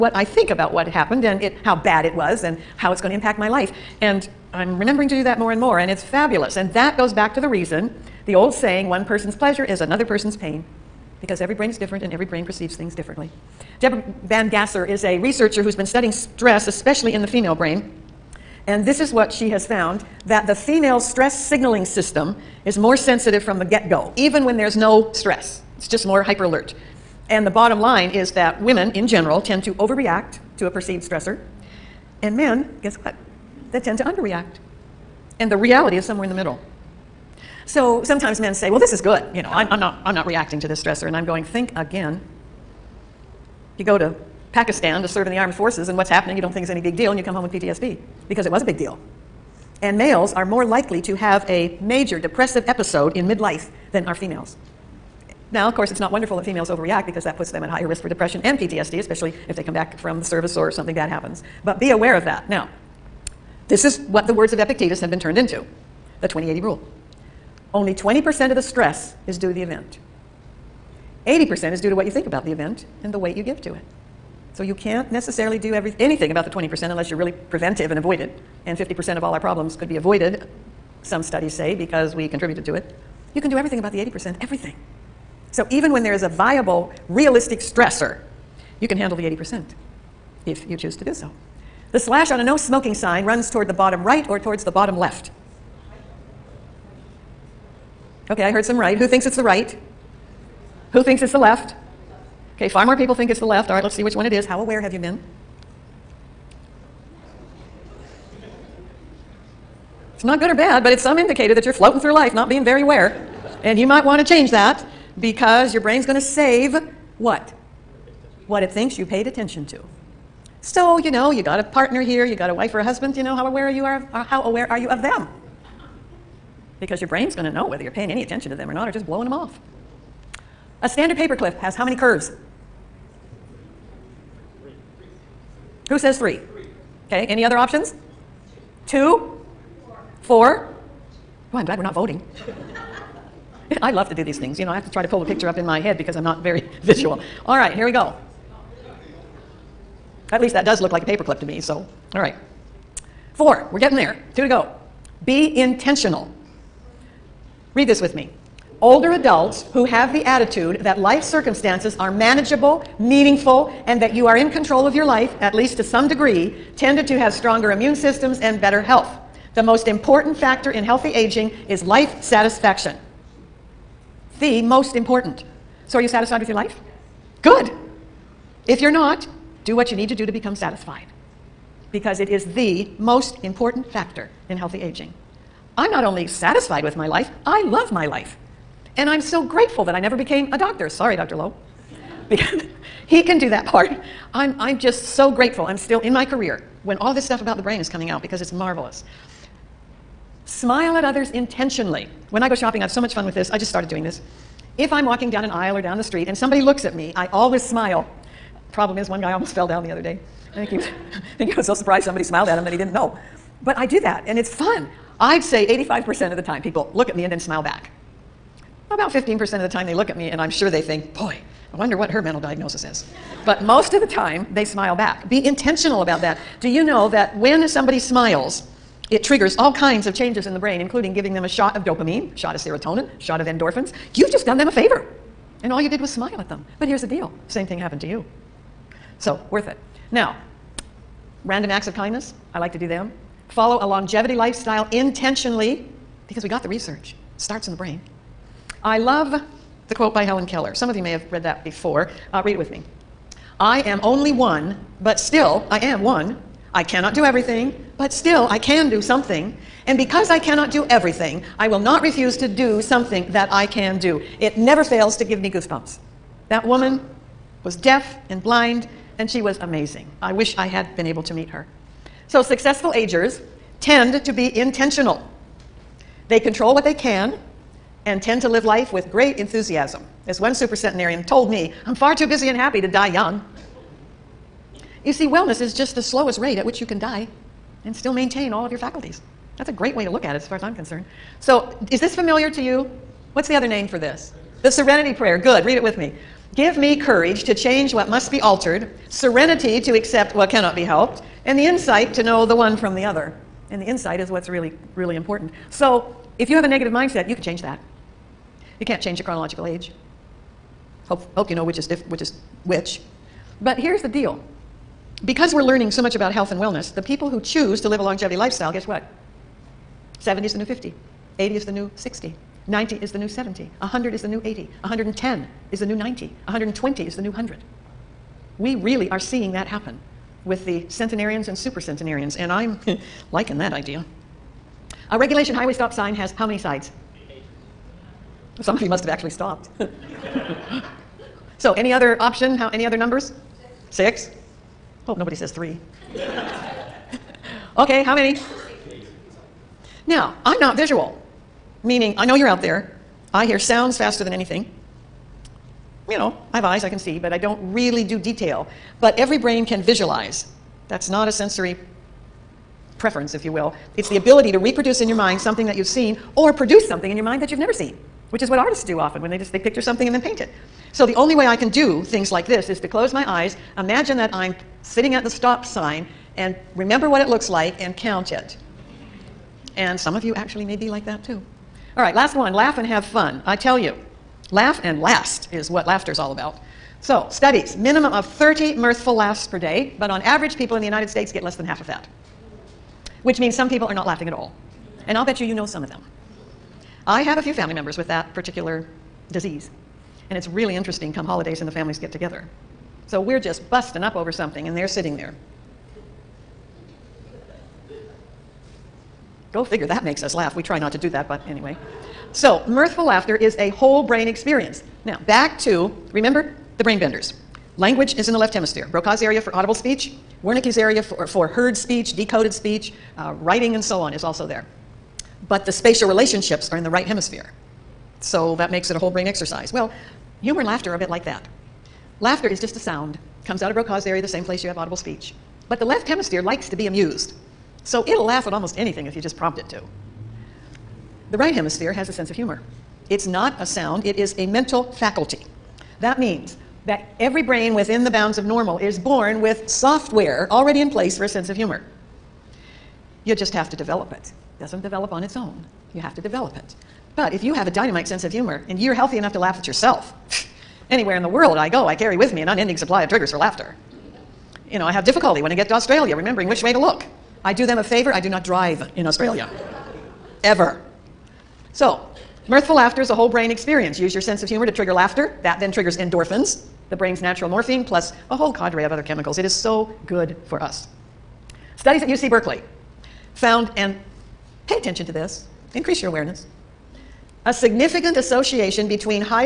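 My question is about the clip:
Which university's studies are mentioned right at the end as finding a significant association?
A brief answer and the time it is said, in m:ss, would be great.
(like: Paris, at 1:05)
UC Berkeley, at 8:02.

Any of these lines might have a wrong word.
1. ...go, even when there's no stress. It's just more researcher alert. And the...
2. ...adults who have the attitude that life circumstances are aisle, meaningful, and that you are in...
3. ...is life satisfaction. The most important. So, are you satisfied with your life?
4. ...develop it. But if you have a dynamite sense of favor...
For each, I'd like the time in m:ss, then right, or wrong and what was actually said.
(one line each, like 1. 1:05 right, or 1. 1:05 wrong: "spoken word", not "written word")
1. 0:23 wrong: "hyper", not "researcher"
2. 2:39 wrong: "manageable", not "aisle"
3. 2:51 right
4. 7:36 wrong: "humor", not "favor".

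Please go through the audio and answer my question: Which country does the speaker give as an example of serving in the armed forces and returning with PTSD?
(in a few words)
Pakistan.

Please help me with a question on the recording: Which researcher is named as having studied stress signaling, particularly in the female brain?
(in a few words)
Deborah Bangasser.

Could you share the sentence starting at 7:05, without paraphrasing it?
But the spatial relationships are in the right hemisphere.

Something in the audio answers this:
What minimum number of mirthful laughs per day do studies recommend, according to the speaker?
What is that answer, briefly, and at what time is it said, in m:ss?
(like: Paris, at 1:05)
30, at 6:28.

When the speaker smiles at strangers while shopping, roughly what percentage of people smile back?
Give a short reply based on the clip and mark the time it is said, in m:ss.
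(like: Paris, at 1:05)
85%, at 3:35.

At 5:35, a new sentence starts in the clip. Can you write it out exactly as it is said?
A regulation highway stop sign has how many sides?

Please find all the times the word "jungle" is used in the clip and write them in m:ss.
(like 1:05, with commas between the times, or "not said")
not said.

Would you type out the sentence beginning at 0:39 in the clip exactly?
You know, I'm, I'm, not, I'm not reacting to this stressor.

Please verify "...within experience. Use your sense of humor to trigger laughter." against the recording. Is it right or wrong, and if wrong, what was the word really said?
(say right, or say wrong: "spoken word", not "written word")
wrong: "brain", not "within".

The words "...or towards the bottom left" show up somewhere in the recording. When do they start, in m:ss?
1:34.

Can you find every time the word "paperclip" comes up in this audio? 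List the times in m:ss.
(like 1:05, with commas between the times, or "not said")
2:11, 2:31.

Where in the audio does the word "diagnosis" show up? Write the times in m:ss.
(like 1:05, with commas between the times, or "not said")
3:42.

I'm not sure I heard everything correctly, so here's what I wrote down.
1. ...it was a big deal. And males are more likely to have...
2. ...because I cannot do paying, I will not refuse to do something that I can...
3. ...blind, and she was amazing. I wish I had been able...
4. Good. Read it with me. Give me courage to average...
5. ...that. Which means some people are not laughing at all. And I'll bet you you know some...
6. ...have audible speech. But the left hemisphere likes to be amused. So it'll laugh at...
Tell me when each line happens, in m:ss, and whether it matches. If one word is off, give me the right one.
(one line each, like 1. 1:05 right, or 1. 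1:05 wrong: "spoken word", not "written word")
1. 0:48 right
2. 4:19 wrong: "everything", not "paying"
3. 4:28 right
4. 4:55 wrong: "change", not "average"
5. 6:31 right
6. 7:14 right.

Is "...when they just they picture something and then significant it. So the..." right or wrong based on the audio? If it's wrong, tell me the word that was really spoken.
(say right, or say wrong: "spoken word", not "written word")
wrong: "paint", not "significant".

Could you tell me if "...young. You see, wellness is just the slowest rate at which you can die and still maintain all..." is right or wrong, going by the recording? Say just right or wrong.
right.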